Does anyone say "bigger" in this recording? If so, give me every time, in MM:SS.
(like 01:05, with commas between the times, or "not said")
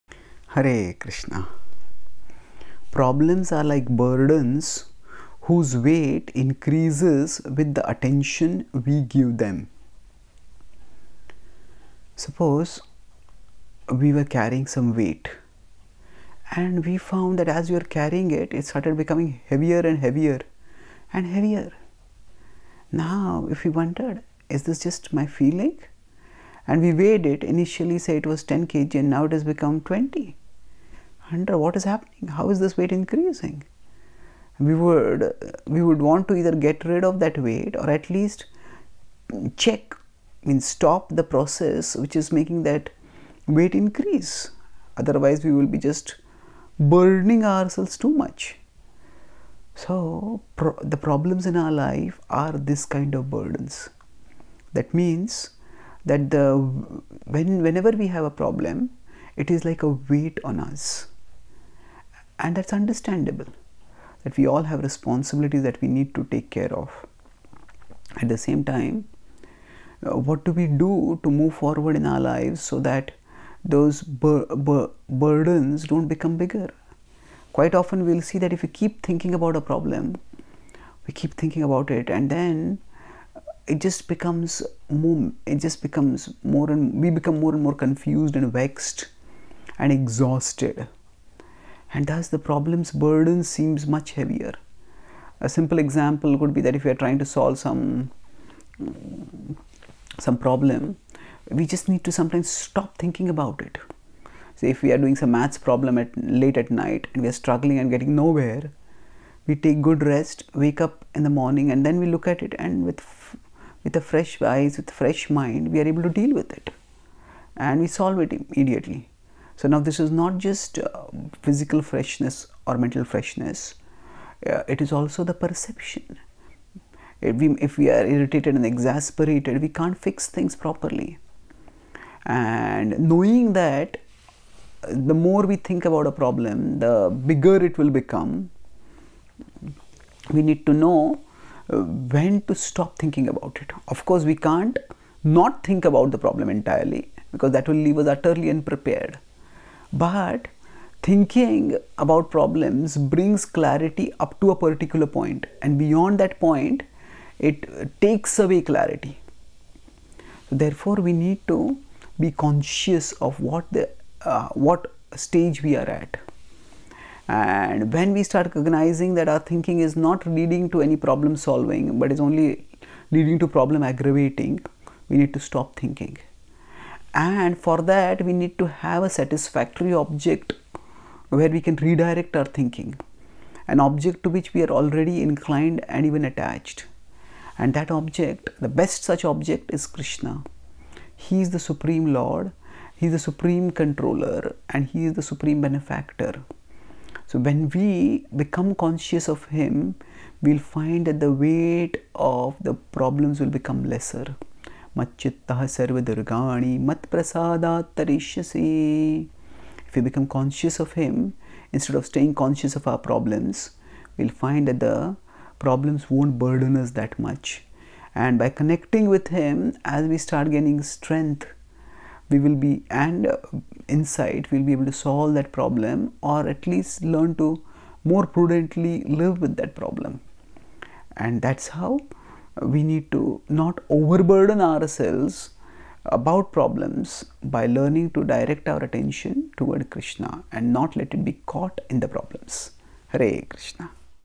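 01:16, 02:17.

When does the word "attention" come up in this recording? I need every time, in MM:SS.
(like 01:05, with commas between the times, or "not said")
00:07, 03:58.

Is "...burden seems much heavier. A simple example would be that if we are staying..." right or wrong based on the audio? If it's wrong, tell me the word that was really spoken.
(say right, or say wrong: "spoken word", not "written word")
wrong: "trying", not "staying".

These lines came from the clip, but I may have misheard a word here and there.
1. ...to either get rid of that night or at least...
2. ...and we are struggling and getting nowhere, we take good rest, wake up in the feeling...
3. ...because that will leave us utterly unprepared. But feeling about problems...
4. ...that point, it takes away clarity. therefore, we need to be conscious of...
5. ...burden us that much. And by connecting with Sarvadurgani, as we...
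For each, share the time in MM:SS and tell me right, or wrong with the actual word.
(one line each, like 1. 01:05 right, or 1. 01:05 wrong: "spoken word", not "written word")
1. 00:36 wrong: "weight", not "night"
2. 01:47 wrong: "morning", not "feeling"
3. 02:27 wrong: "thinking", not "feeling"
4. 02:36 right
5. 03:36 wrong: "Him", not "Sarvadurgani".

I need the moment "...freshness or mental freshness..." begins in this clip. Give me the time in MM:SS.
02:01.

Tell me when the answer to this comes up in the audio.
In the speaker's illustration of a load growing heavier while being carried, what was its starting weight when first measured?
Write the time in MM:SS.
00:28.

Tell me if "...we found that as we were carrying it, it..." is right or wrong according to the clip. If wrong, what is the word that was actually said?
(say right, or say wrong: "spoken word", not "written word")
right.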